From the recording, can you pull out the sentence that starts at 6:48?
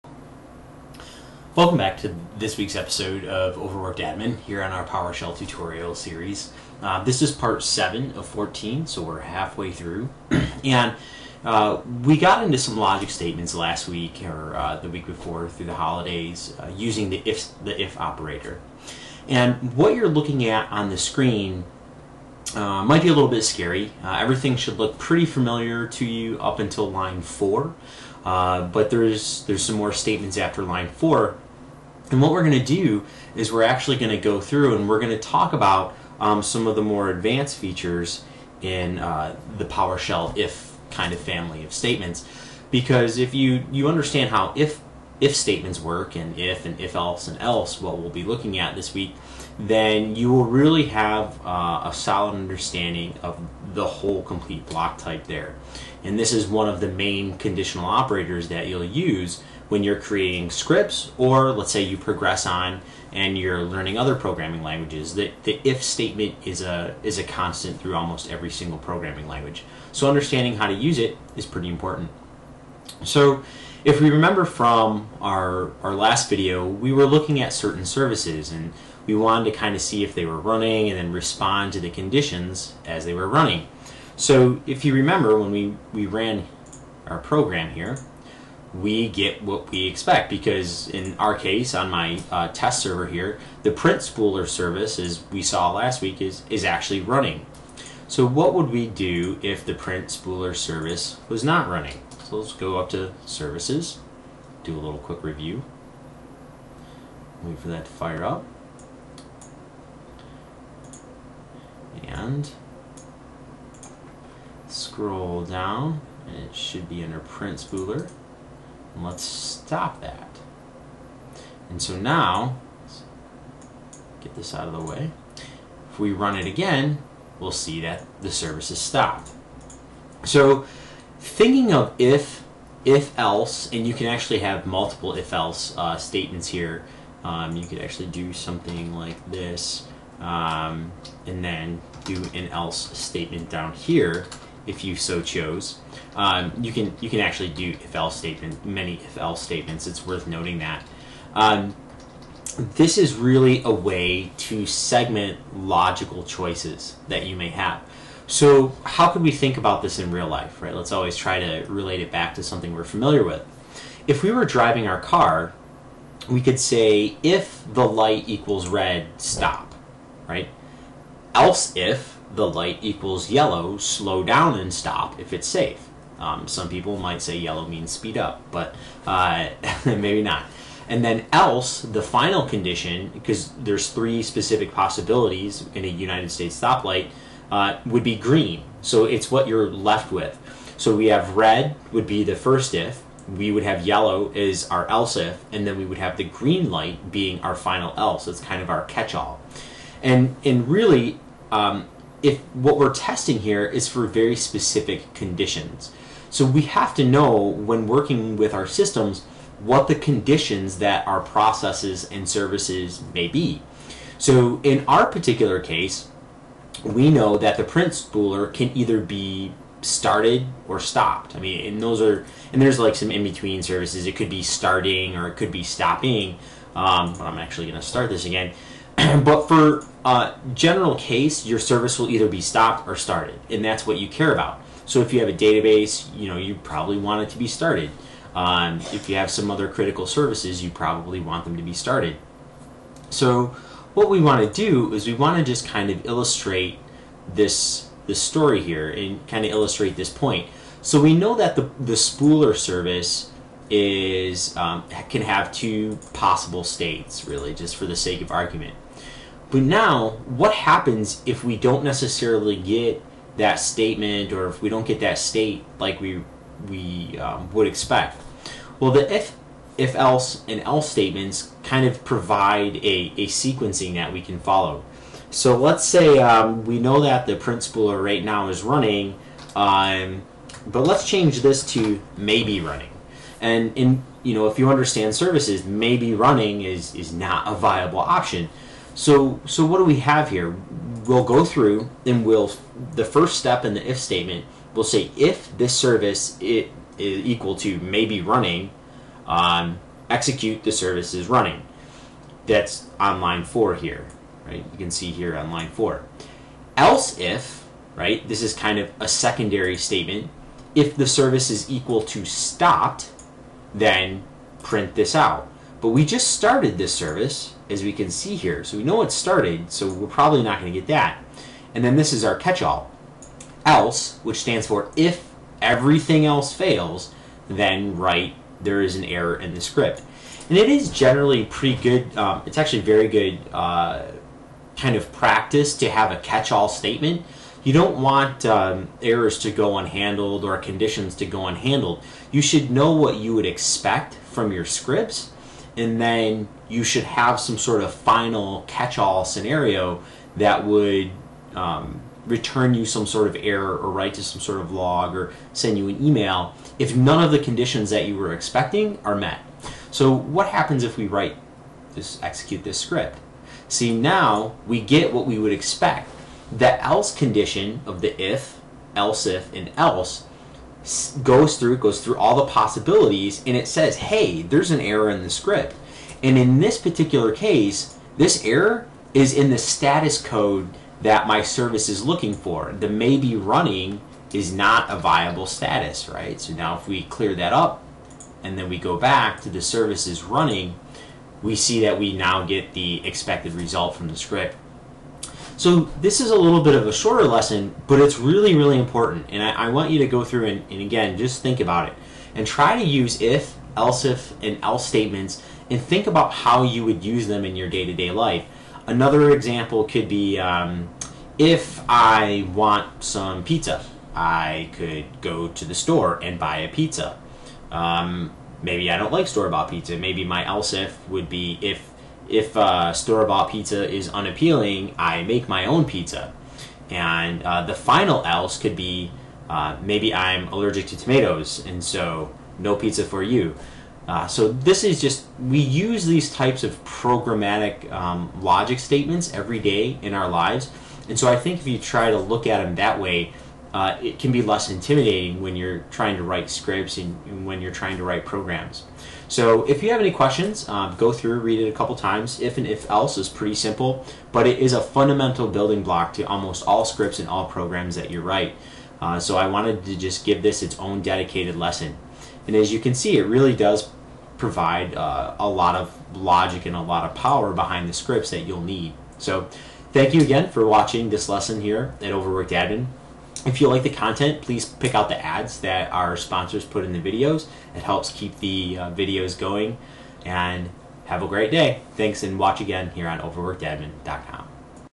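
Another example could be um, if I want some pizza, I could go to the store and buy a pizza.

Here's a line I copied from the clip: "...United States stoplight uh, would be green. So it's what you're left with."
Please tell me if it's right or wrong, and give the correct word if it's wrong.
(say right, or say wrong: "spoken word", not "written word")
right.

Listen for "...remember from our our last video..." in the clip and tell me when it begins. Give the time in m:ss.
1:14.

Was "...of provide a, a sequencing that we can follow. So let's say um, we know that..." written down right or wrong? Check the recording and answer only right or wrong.
right.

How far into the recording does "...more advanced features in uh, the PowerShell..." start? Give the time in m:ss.
0:36.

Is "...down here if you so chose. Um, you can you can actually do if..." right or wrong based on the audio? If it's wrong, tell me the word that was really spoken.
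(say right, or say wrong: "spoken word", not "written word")
right.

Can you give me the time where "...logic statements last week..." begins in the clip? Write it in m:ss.
0:12.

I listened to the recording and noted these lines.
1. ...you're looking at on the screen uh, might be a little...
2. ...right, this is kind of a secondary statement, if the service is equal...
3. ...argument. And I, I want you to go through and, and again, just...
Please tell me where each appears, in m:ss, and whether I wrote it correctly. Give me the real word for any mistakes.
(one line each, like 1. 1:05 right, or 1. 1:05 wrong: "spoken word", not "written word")
1. 0:19 right
2. 5:07 right
3. 6:38 wrong: "important", not "argument".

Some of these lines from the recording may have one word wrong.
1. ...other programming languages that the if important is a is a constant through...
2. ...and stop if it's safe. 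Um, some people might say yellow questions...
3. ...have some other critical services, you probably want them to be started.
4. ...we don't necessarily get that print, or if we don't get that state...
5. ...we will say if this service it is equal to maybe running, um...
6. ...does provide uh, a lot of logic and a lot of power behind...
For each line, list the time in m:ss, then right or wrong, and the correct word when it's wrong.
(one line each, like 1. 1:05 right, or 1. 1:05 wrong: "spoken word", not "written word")
1. 1:03 wrong: "statement", not "important"
2. 2:54 wrong: "means", not "questions"
3. 3:59 right
4. 4:21 wrong: "statement", not "print"
5. 4:54 right
6. 7:43 right.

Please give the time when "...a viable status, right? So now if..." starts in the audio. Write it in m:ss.
6:24.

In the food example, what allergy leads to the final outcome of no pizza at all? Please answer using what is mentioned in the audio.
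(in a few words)
Tomatoes.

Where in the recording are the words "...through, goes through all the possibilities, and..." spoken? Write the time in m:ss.
6:11.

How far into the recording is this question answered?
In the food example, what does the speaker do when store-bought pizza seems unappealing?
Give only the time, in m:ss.
7:04.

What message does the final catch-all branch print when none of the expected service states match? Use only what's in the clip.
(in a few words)
There is an error in the script.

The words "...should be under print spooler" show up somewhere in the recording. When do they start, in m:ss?
1:56.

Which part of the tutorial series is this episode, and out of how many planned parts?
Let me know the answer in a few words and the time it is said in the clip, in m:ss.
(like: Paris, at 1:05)
7 of 14, at 0:07.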